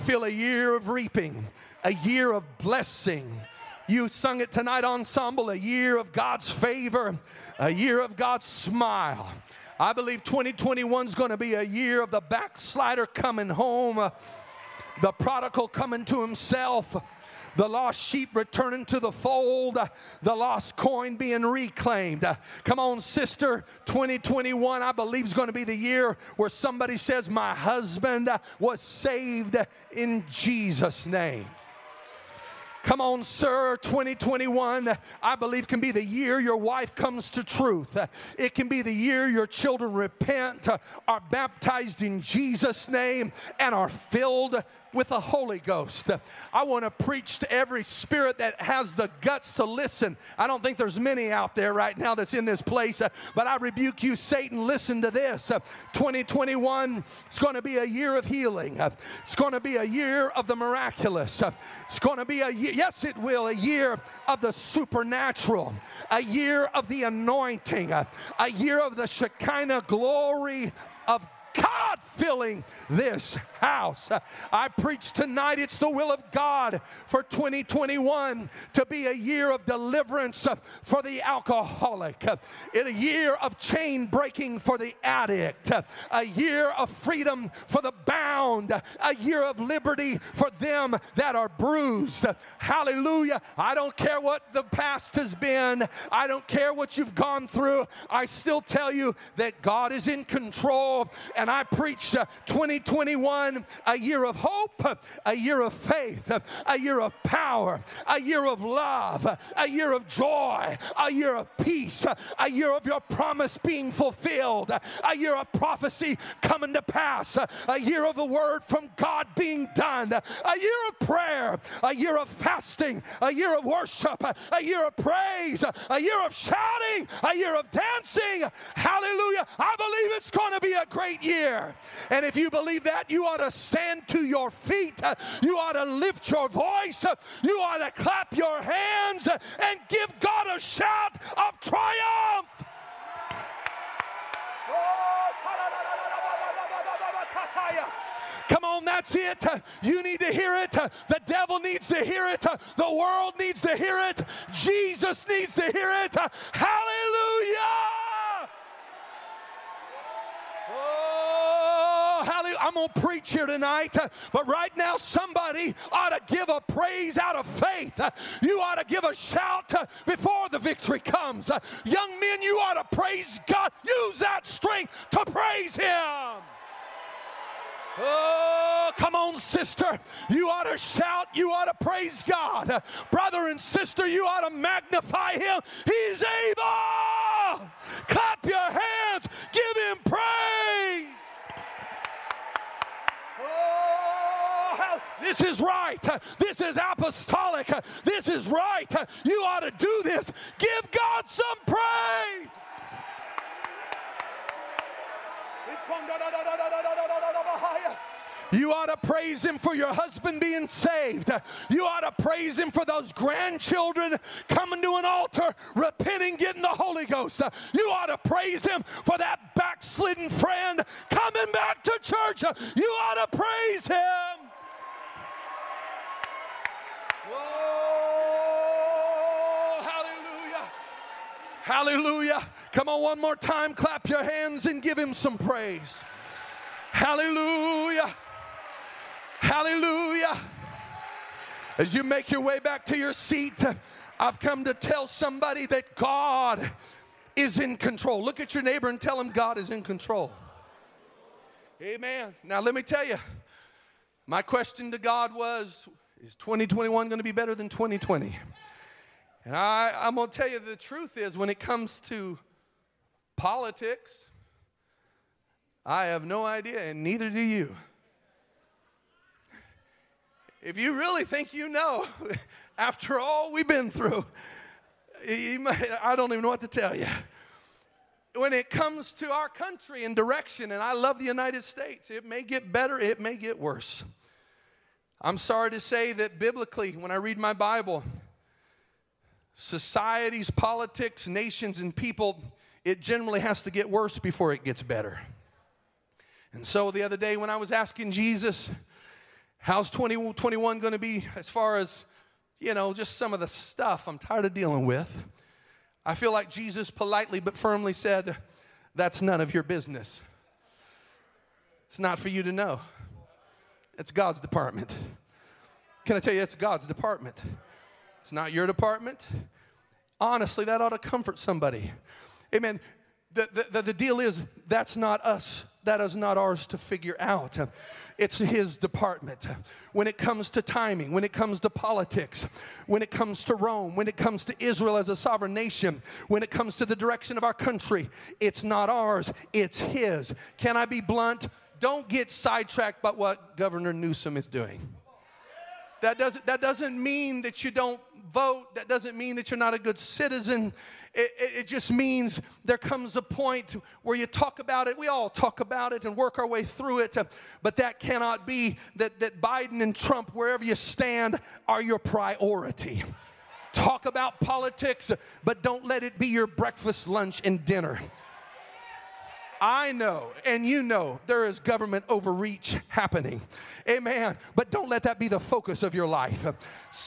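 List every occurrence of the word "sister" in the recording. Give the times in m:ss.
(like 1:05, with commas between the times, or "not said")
0:23, 2:59, 3:03.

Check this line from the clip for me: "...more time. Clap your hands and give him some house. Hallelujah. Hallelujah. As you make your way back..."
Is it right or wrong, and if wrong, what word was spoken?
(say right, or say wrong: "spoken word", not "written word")
wrong: "praise", not "house".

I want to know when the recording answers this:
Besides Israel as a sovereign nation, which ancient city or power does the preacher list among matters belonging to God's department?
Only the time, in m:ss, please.
5:33.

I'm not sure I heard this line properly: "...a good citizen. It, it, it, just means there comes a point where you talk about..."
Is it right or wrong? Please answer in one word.
right.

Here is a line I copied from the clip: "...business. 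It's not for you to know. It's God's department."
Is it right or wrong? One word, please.
right.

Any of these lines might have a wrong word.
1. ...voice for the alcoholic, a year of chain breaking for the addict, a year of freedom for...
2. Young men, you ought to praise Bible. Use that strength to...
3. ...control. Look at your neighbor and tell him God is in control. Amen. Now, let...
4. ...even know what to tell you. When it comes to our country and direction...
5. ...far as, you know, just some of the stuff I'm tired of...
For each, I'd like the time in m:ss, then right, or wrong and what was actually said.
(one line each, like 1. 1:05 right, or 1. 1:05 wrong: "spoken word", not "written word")
1. 1:19 wrong: "deliverance", not "voice"
2. 2:51 wrong: "God", not "Bible"
3. 4:07 right
4. 4:36 right
5. 5:01 right.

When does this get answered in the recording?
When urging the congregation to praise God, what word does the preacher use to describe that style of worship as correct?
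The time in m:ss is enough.
3:16.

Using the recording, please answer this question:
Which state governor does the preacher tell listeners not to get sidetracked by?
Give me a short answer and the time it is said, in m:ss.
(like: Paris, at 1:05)
Governor Newsom, at 5:43.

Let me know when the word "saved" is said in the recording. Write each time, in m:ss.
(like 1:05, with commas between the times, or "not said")
0:28, 3:30.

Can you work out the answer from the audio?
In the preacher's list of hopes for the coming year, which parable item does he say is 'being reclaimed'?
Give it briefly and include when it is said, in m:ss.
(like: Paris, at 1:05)
the lost coin, at 0:20.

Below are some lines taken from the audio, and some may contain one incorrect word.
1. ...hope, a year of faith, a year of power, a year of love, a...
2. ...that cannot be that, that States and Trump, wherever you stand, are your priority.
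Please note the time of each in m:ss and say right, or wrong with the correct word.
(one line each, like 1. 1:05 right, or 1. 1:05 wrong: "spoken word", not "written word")
1. 1:44 right
2. 5:57 wrong: "Biden", not "States".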